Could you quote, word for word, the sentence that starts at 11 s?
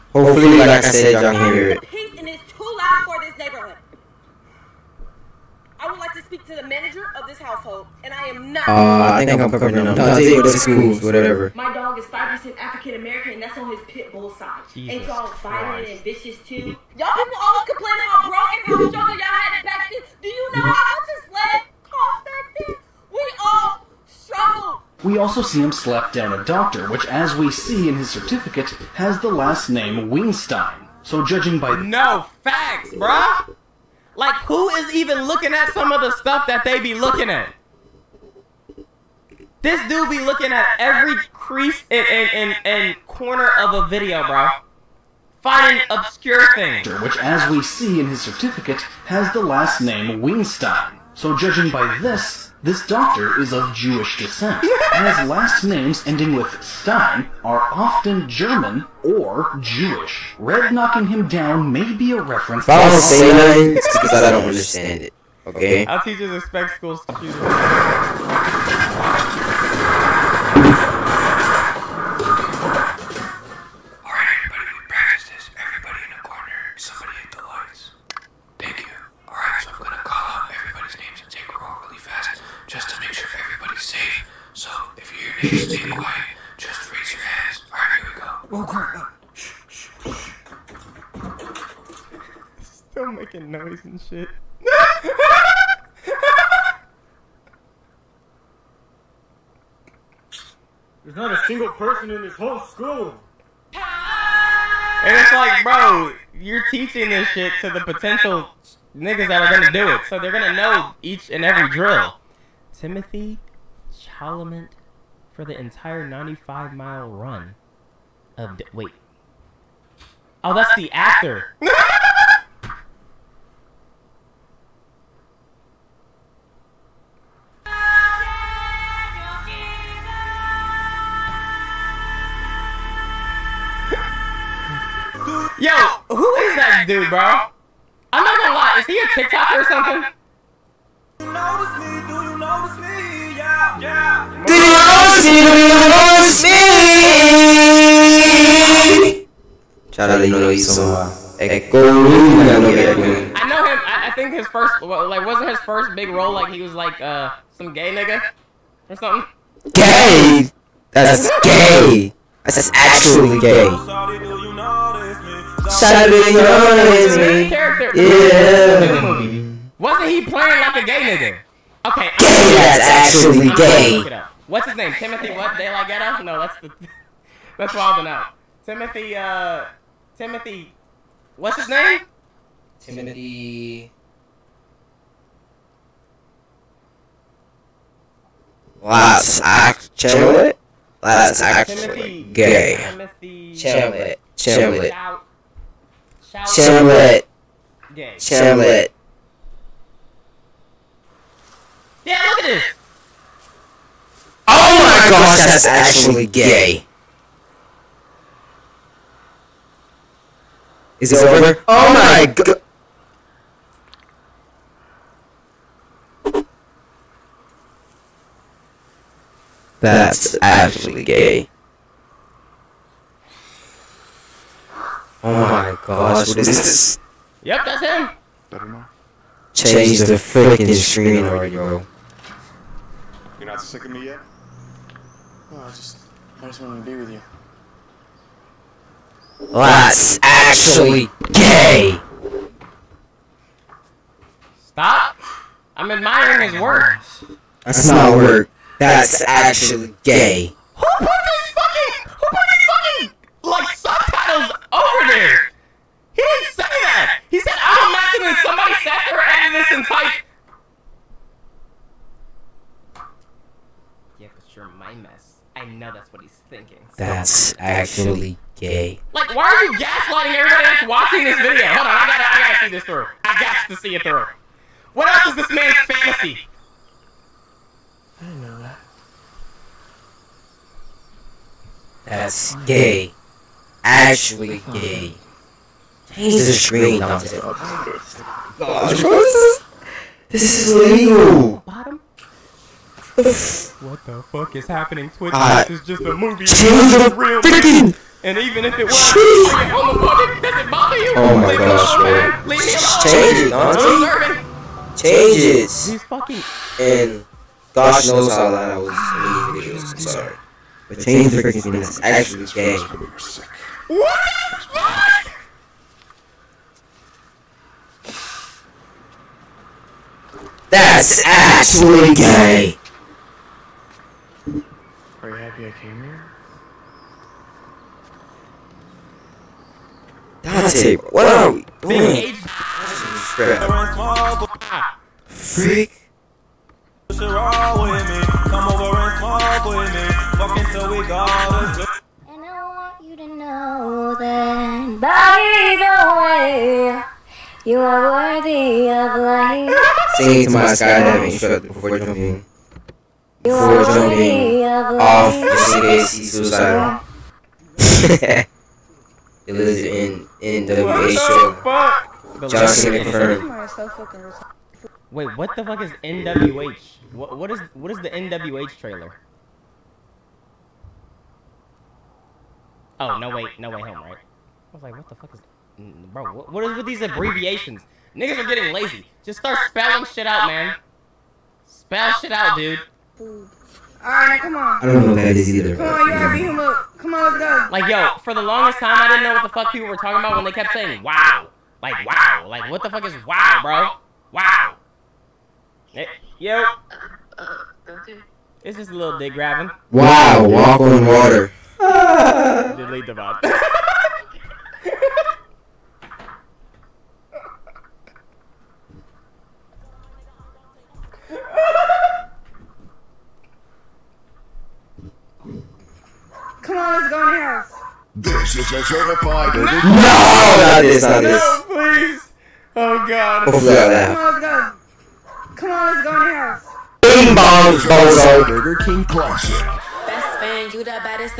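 My dog is 5% African American, and that's on his pit bull side.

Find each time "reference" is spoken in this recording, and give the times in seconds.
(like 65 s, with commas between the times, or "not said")
62 s.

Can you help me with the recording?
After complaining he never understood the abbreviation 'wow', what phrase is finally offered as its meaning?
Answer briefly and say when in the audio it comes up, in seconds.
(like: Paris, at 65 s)
walk on water, at 400 s.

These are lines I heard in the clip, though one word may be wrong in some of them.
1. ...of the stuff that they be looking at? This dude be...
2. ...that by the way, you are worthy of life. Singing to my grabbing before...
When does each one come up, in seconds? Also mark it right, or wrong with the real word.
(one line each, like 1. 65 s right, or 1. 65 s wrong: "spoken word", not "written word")
1. 35 s right
2. 344 s wrong: "skydiving", not "grabbing".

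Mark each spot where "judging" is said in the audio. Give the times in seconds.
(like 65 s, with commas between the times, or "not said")
31 s, 51 s.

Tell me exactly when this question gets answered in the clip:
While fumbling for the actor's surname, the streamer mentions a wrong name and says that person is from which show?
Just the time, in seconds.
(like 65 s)
177 s.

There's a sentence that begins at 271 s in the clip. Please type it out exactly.
Hold on, I gotta, I gotta see this through.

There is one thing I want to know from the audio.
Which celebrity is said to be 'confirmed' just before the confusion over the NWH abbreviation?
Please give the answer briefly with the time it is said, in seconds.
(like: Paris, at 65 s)
John Cena, at 362 s.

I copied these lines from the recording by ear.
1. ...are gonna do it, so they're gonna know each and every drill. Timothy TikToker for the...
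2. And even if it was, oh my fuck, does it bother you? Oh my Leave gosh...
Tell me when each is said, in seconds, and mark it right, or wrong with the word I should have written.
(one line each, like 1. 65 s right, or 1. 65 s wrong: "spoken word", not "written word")
1. 109 s wrong: "Chalamet", not "TikToker"
2. 298 s right.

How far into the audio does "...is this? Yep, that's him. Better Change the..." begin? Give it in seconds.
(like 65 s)
226 s.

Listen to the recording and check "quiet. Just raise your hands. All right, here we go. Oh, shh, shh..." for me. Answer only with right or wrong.
right.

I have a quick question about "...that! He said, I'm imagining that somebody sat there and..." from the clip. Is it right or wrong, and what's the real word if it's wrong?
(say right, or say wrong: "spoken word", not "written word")
right.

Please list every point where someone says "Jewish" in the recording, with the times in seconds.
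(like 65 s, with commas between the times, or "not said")
53 s, 59 s.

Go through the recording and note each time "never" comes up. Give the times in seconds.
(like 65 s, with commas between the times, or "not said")
not said.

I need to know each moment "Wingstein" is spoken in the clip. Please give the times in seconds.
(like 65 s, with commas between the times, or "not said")
30 s, 50 s.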